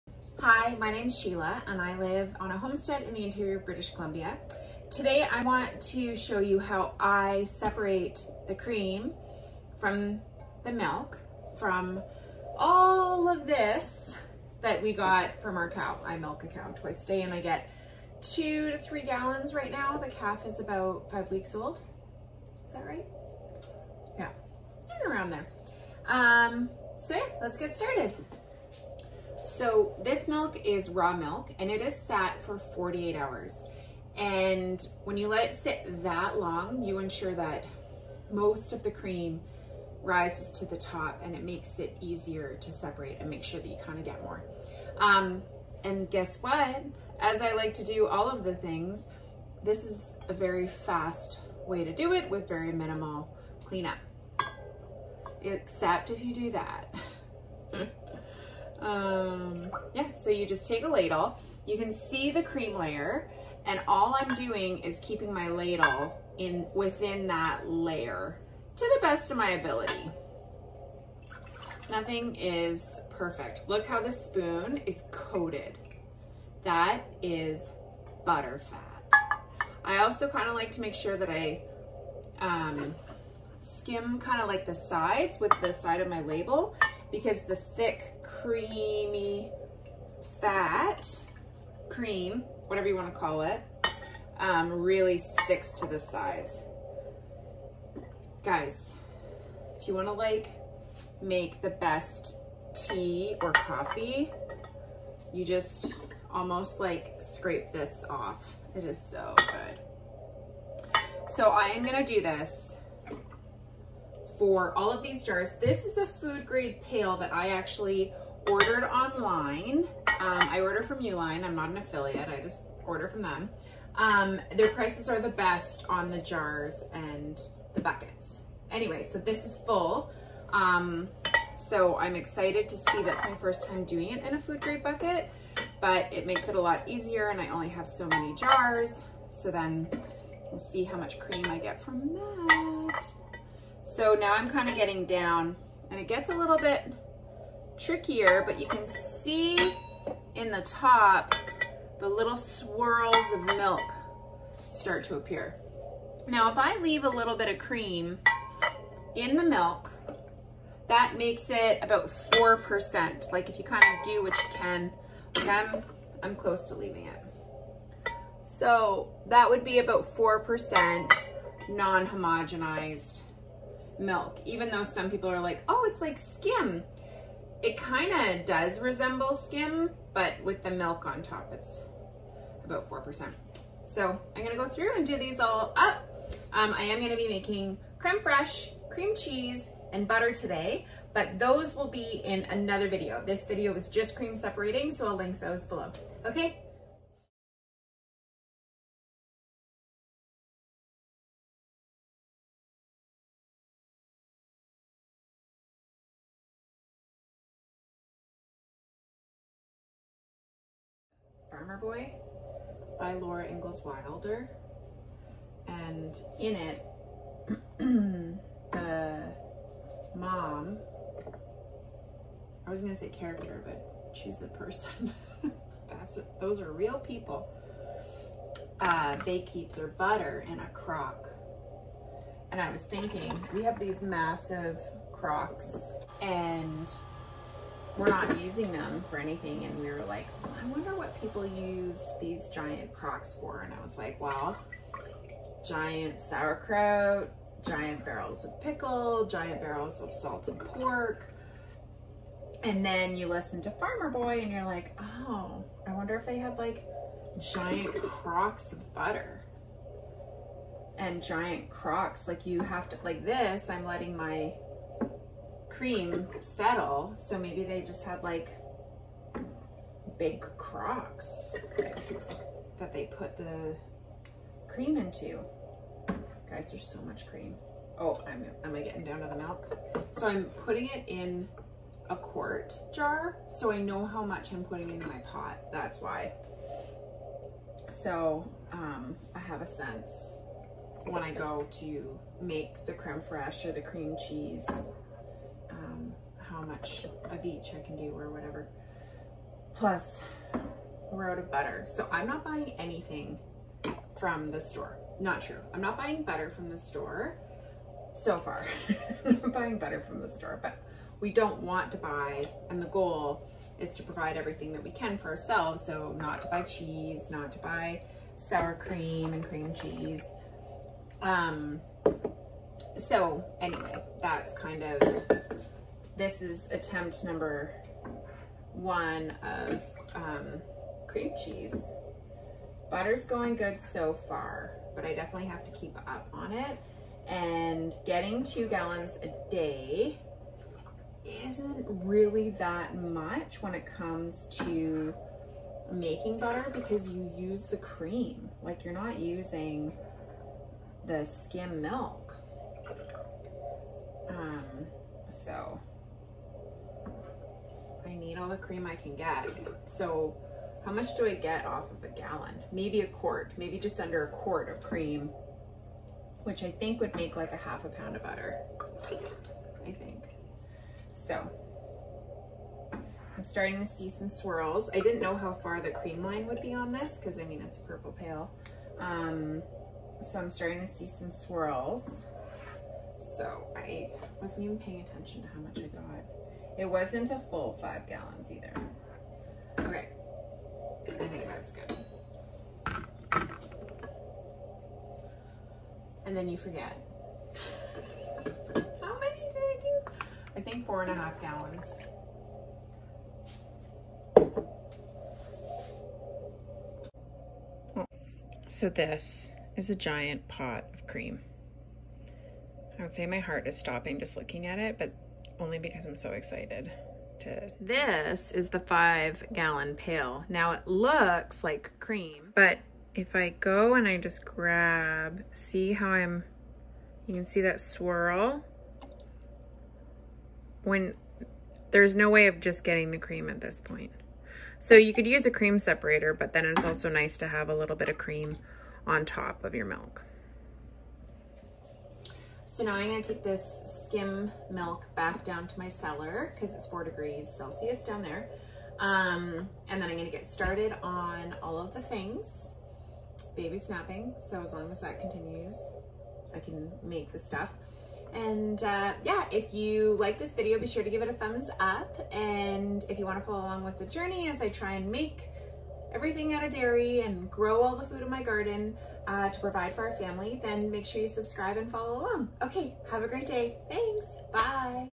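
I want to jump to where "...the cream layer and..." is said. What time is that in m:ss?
1:02.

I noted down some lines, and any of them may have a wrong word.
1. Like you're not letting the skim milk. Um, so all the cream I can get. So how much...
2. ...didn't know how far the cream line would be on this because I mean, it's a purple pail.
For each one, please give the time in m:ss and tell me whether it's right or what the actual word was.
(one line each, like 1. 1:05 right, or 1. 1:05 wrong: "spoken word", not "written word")
1. 5:48 wrong: "using", not "letting"
2. 6:14 right.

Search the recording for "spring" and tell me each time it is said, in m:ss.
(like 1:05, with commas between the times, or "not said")
not said.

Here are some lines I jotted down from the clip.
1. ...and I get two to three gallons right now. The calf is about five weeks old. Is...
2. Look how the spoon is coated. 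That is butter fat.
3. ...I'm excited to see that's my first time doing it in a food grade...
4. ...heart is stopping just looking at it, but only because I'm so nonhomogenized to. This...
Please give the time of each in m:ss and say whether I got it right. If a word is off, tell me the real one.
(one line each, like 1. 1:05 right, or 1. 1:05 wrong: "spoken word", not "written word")
1. 0:17 right
2. 1:13 right
3. 2:11 right
4. 6:53 wrong: "excited", not "nonhomogenized".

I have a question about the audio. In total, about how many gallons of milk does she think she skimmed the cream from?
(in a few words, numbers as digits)
4.5 gallons.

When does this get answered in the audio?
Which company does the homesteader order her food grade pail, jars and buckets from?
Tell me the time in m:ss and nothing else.
2:00.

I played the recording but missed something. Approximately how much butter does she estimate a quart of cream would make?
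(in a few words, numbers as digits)
half a pound.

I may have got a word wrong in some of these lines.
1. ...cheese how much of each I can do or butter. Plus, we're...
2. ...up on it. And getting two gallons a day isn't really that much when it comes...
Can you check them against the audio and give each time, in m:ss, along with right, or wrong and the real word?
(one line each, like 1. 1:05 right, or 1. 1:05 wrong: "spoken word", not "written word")
1. 4:54 wrong: "whatever", not "butter"
2. 5:35 right.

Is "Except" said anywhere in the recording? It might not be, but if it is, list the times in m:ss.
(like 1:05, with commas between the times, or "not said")
0:55.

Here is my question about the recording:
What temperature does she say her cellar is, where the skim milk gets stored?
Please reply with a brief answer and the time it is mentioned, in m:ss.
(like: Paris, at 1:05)
4 degrees Celsius, at 7:26.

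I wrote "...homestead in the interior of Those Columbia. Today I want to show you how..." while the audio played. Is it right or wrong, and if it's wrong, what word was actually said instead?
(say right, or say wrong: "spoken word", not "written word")
wrong: "British", not "Those".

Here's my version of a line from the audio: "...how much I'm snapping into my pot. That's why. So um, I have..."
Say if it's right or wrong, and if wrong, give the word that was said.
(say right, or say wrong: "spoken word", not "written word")
wrong: "putting", not "snapping".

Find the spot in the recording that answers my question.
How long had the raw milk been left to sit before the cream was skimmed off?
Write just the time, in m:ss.
0:32.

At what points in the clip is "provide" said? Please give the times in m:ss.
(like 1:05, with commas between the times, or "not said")
5:14, 7:49.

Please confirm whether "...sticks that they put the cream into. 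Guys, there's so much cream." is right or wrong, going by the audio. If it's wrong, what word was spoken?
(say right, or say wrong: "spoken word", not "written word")
wrong: "crocks", not "sticks".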